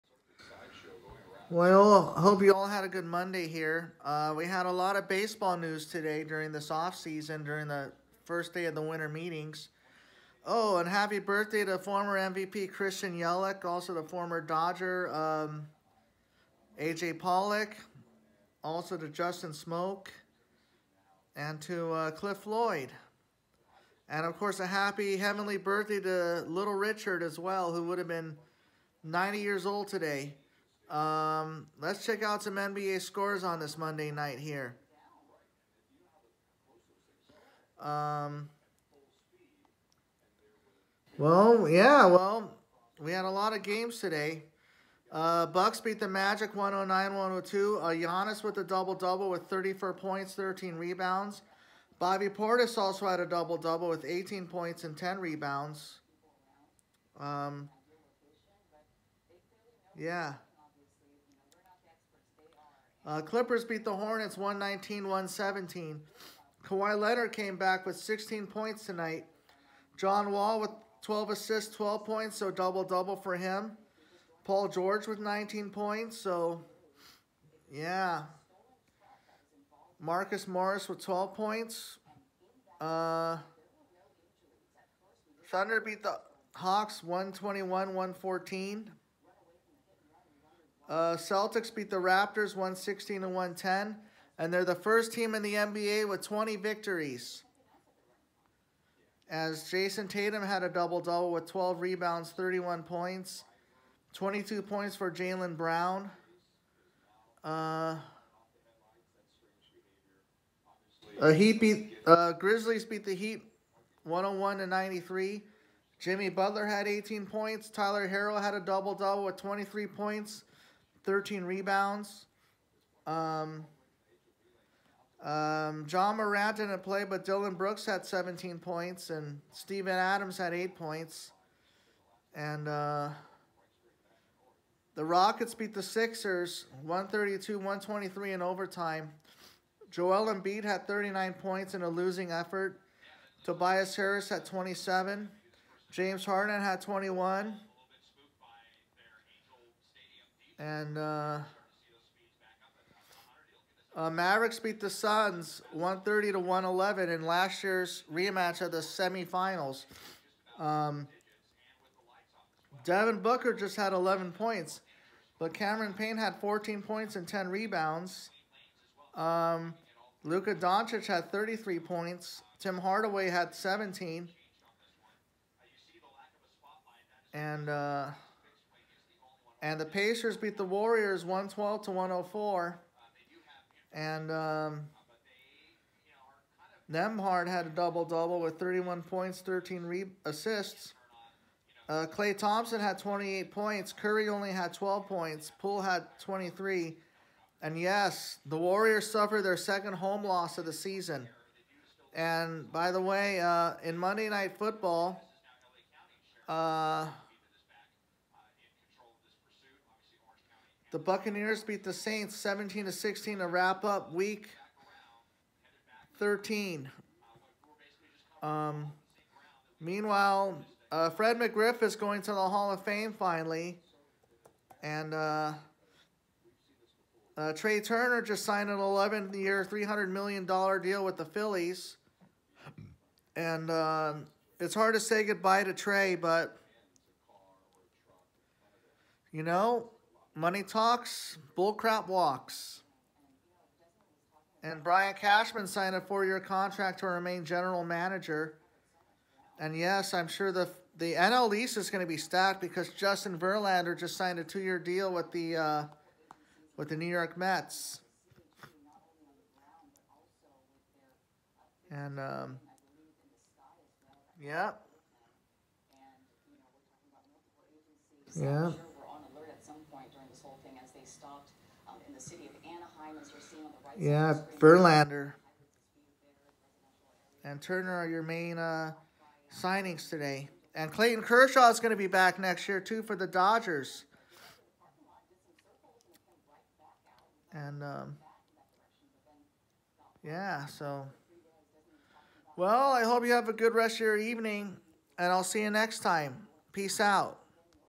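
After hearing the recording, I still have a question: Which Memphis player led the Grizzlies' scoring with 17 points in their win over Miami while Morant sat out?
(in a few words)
Dillon Brooks.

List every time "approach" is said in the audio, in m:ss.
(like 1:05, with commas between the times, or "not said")
not said.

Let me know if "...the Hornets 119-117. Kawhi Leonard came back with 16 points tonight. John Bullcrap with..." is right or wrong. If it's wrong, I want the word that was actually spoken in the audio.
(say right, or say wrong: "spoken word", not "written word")
wrong: "Wall", not "Bullcrap".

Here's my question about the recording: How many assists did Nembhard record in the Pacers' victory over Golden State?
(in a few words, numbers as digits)
13.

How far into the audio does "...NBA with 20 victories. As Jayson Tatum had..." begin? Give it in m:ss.
1:35.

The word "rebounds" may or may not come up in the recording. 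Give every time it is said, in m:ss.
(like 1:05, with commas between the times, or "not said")
0:50, 0:55, 1:41, 2:01, 2:47.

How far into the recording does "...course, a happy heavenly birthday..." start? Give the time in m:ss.
0:24.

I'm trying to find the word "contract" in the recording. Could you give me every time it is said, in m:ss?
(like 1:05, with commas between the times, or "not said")
4:06.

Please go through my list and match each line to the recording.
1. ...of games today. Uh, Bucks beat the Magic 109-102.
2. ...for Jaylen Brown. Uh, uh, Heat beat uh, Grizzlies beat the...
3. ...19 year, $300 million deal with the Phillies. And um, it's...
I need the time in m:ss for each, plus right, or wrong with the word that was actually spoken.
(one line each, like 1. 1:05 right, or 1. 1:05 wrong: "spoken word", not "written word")
1. 0:43 right
2. 1:44 right
3. 3:48 wrong: "11", not "19".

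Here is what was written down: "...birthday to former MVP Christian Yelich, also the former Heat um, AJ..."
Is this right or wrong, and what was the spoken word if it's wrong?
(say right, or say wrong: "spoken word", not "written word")
wrong: "Dodger", not "Heat".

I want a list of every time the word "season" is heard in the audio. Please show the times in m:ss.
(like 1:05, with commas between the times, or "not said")
0:06, 3:20.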